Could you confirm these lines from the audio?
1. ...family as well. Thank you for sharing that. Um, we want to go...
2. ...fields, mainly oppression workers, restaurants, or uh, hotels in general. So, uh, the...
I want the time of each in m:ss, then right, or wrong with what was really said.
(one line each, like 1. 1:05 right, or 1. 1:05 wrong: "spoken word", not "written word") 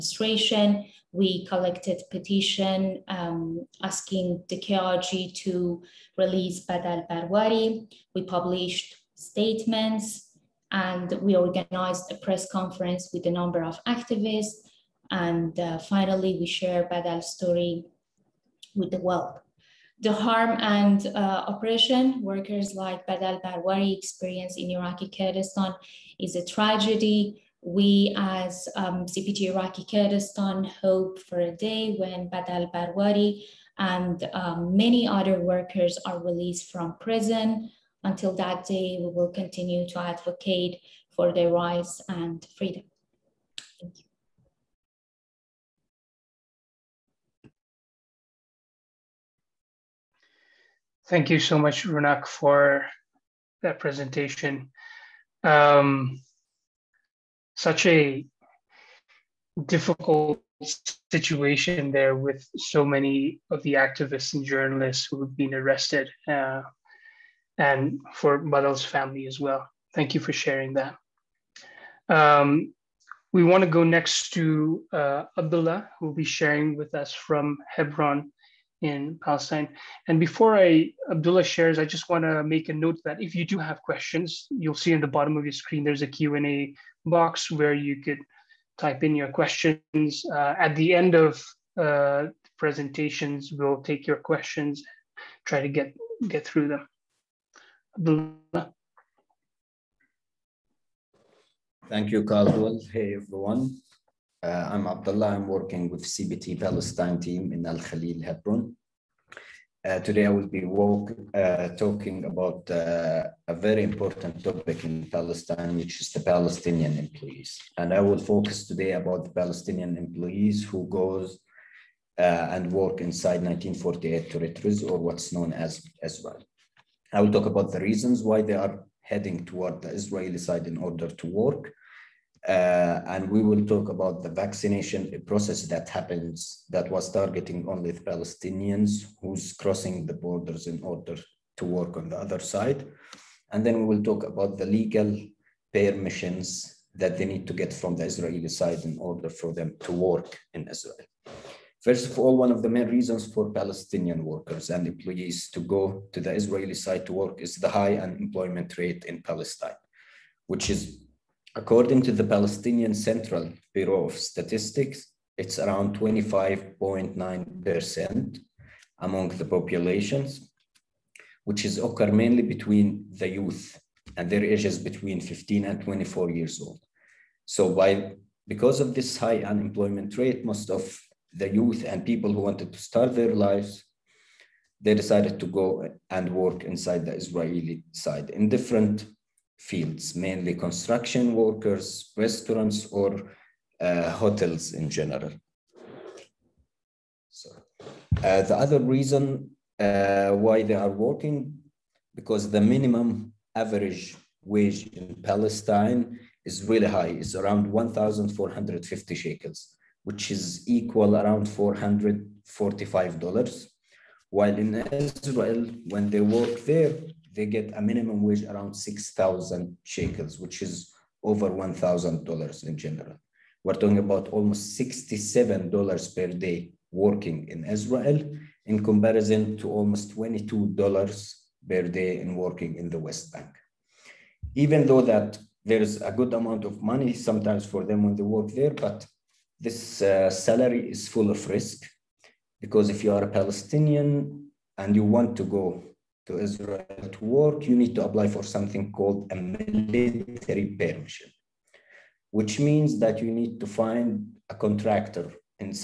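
1. 1:08 right
2. 3:09 wrong: "construction", not "oppression".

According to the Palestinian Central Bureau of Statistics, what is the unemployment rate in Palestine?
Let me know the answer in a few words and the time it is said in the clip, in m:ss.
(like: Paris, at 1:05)
25.9%, at 2:45.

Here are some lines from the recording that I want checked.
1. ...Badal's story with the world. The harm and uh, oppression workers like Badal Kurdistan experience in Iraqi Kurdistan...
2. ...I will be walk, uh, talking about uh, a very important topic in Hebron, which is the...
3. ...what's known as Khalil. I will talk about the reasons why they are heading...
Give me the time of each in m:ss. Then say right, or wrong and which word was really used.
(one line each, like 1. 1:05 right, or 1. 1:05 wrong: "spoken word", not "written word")
1. 0:16 wrong: "Barwari", not "Kurdistan"
2. 1:50 wrong: "Palestine", not "Hebron"
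3. 2:04 wrong: "Israel", not "Khalil".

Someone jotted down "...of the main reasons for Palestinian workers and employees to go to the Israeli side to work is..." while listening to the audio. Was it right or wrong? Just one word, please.
right.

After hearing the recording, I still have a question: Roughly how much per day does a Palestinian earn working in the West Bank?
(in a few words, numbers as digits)
$22.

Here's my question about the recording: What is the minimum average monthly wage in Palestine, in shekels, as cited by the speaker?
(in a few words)
1,450 shekels.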